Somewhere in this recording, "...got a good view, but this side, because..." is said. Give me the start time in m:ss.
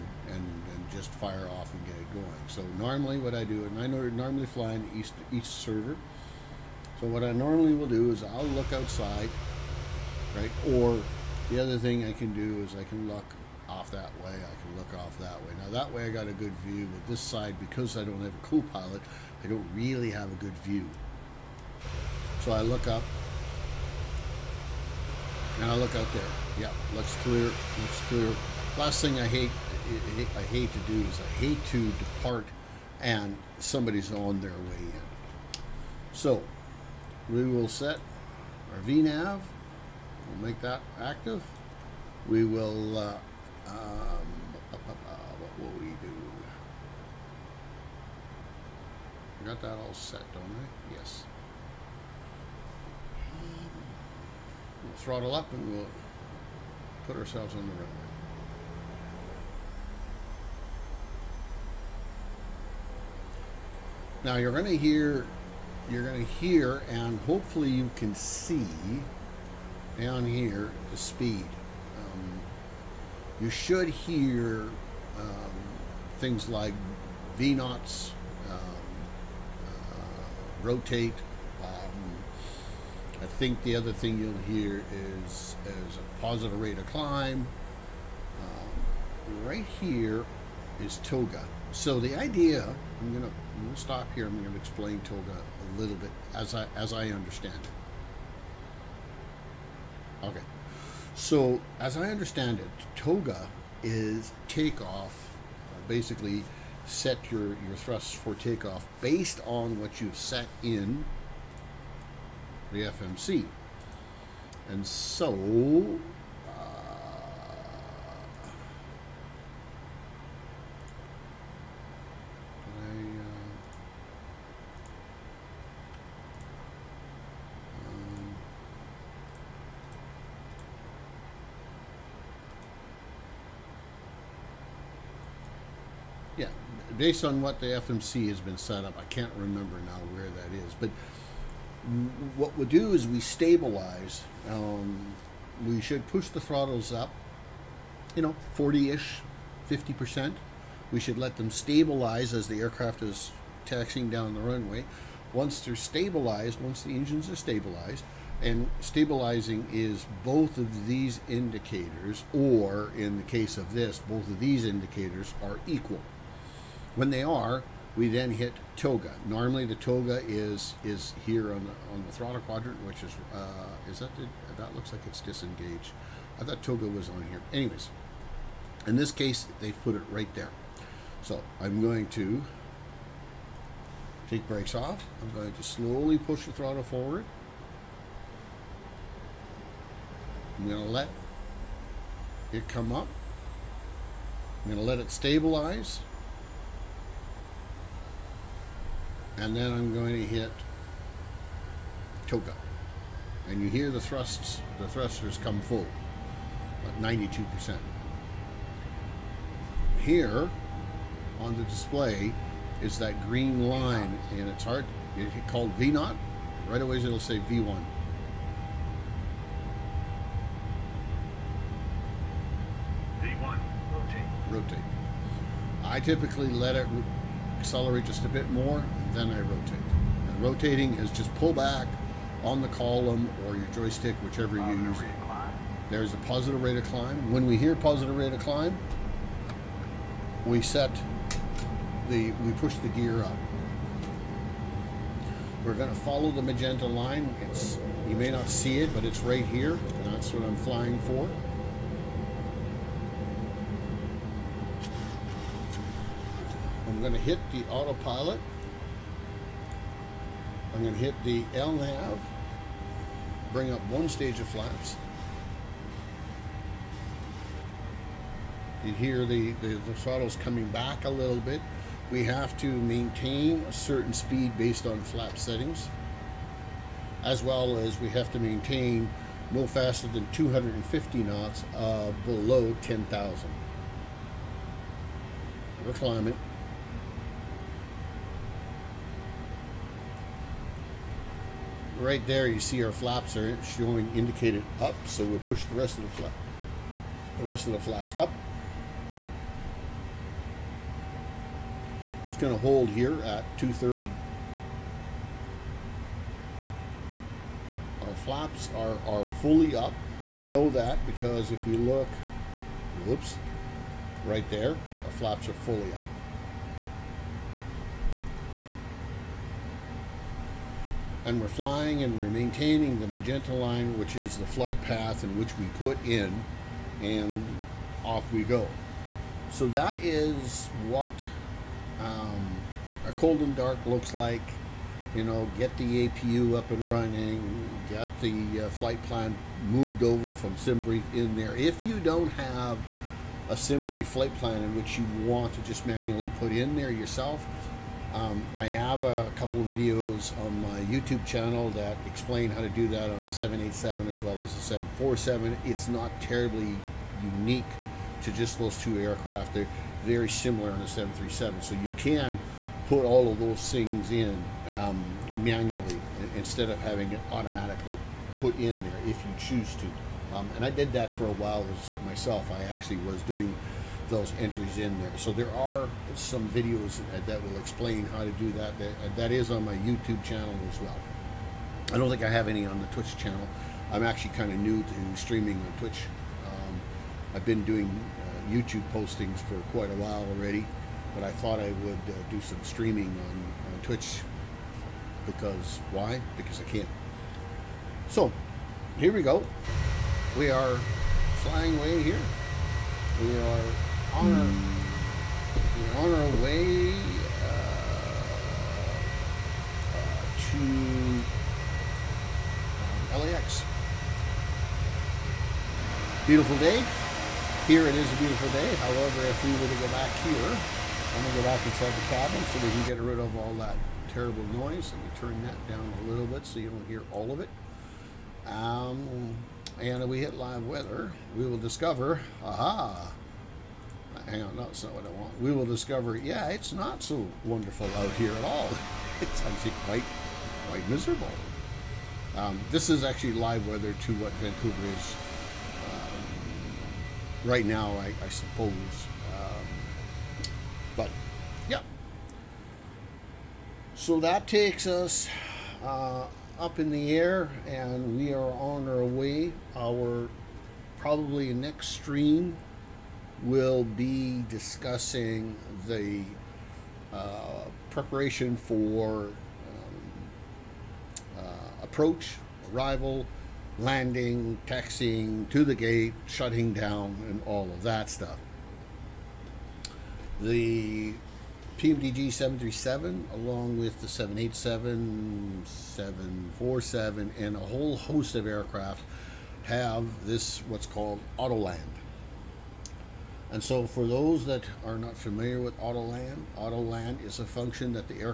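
0:16.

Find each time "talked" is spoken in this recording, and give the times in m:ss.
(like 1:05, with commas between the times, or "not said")
not said.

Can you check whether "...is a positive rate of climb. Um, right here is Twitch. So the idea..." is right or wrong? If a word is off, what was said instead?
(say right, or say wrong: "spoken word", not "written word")
wrong: "TOGA", not "Twitch".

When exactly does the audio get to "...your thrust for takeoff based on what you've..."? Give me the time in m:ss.
1:47.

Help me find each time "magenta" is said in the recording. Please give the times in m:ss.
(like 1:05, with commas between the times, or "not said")
4:06, 5:23.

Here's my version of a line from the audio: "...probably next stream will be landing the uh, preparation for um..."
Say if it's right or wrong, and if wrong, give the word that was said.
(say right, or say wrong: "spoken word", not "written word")
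wrong: "discussing", not "landing".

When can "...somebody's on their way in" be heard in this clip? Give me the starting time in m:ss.
0:33.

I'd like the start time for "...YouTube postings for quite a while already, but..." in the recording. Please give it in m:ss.
6:28.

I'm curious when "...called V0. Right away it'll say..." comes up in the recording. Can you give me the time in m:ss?
3:35.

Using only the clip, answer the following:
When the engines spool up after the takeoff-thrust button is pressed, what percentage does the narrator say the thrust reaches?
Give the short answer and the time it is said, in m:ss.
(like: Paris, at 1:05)
92%, at 3:27.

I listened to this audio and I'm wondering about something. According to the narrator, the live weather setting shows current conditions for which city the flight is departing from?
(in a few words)
Vancouver.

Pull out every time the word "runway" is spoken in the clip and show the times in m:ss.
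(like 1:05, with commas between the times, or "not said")
0:57, 2:34.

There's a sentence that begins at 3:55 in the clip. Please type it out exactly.
There's a positive rate of climb.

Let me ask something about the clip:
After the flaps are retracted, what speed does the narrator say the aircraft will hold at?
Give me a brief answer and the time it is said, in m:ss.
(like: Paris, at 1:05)
230, at 5:03.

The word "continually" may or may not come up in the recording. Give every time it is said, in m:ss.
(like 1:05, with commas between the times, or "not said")
not said.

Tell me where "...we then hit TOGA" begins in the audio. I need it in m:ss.
2:47.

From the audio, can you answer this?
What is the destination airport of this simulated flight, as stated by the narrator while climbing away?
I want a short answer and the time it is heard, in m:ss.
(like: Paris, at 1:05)
LAX, at 6:53.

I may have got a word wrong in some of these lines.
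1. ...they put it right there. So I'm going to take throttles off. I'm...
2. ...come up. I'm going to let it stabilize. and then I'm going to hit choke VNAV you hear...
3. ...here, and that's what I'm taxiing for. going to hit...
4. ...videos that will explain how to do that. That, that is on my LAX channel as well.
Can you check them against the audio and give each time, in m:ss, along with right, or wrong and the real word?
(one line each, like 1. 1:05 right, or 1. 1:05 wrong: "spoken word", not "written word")
1. 2:59 wrong: "brakes", not "throttles"
2. 3:12 wrong: "And", not "VNAV"
3. 4:09 wrong: "flying", not "taxiing"
4. 6:16 wrong: "YouTube", not "LAX".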